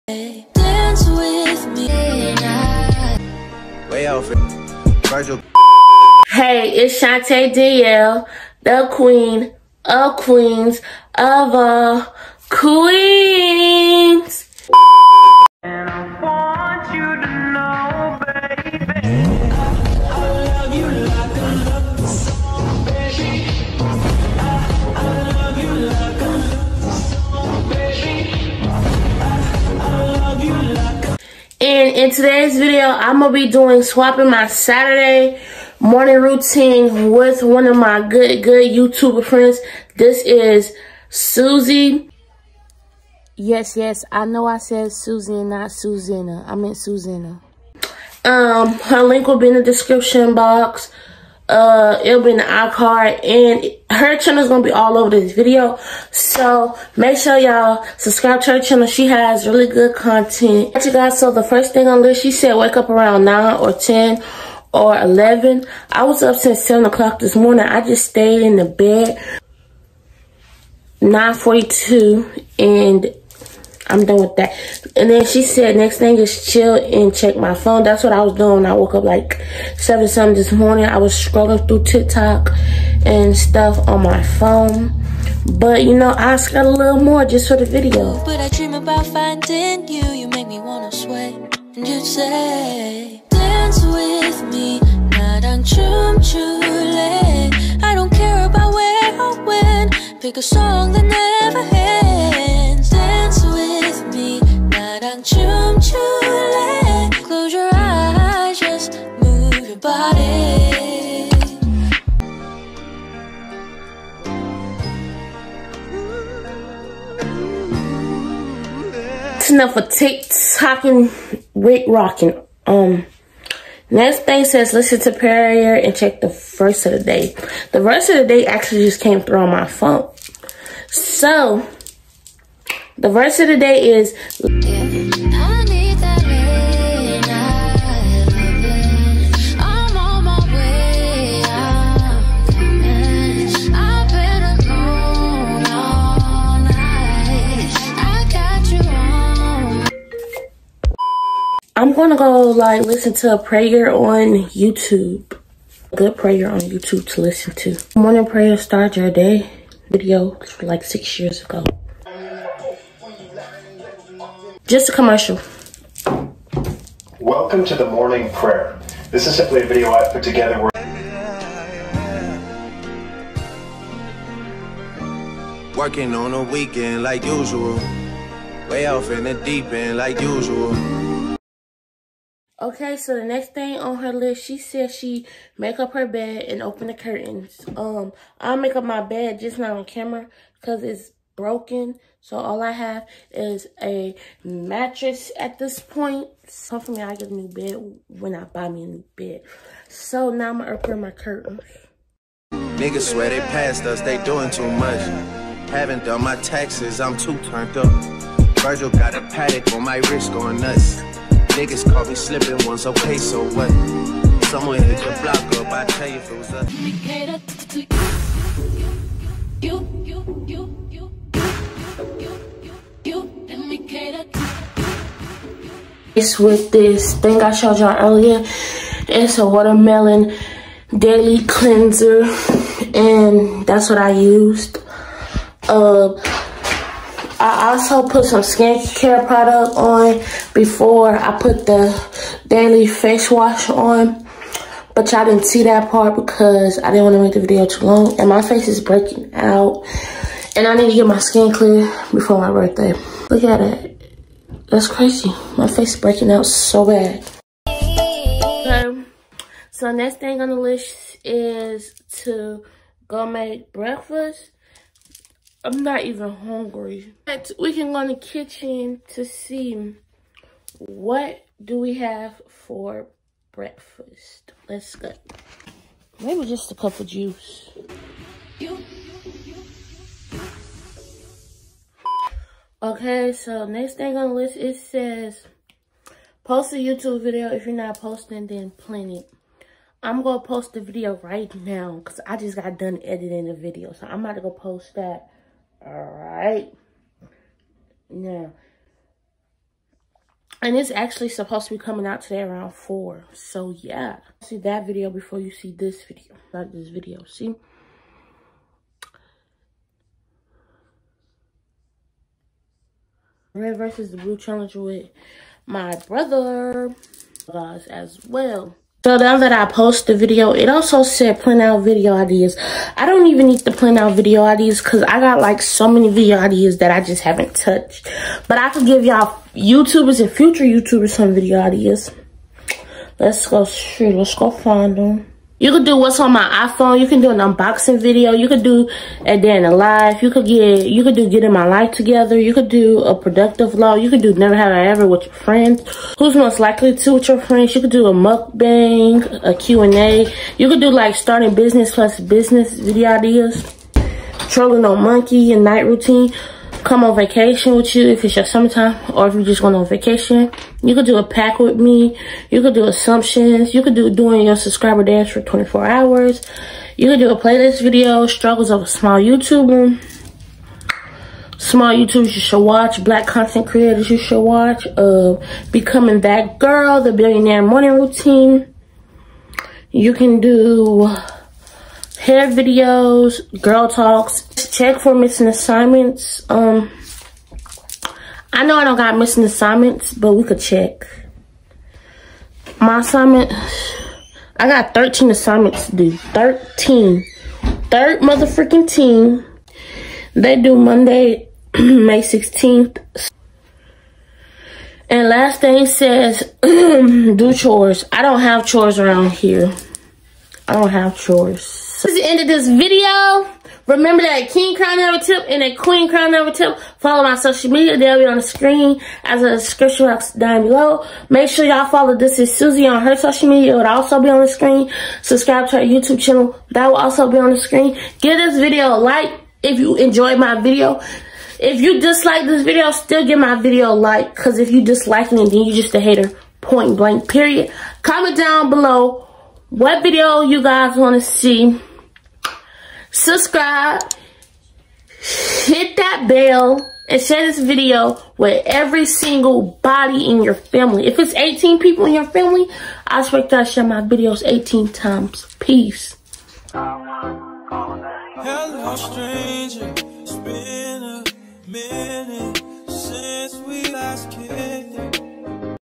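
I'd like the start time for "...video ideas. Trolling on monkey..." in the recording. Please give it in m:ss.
5:52.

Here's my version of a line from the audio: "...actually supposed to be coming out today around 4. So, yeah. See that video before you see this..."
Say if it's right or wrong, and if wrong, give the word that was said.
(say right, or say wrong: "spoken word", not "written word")
right.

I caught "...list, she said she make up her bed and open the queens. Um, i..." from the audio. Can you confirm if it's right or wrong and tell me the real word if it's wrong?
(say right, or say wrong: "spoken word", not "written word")
wrong: "curtains", not "queens".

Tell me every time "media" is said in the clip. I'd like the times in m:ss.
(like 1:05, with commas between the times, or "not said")
6:57, 7:03.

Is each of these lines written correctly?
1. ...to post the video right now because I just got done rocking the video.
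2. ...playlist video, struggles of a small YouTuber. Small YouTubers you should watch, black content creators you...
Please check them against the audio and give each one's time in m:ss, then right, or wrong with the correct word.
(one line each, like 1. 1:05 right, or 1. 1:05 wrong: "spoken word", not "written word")
1. 4:50 wrong: "editing", not "rocking"
2. 6:07 right.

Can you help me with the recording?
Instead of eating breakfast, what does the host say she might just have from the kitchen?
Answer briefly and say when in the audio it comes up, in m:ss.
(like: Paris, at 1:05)
A cup of juice, at 4:36.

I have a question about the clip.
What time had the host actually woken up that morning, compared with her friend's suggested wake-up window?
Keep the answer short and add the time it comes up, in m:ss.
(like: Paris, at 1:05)
7 o'clock, at 1:06.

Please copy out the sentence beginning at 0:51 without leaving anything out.
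Uh, it'll be in the iCard and her channel is going to be all over this video.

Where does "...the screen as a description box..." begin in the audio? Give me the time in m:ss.
6:58.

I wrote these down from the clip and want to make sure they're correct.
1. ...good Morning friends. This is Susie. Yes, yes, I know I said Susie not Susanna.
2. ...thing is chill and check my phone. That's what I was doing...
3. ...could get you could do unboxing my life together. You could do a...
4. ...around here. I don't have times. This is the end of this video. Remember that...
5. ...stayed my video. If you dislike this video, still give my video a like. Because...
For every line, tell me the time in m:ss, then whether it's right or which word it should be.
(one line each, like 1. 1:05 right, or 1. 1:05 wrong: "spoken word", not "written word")
1. 0:38 wrong: "YouTuber", not "Morning"
2. 1:15 right
3. 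5:40 wrong: "getting", not "unboxing"
4. 6:48 wrong: "chores", not "times"
5. 7:09 wrong: "enjoyed", not "stayed".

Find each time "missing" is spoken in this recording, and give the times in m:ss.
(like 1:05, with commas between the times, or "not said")
6:25, 6:29.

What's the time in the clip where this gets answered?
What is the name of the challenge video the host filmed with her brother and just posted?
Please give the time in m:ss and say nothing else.
5:13.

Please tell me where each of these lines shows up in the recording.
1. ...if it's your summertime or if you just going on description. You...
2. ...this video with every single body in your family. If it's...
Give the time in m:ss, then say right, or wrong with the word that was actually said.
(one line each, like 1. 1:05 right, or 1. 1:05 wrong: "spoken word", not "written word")
1. 5:58 wrong: "vacation", not "description"
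2. 7:27 right.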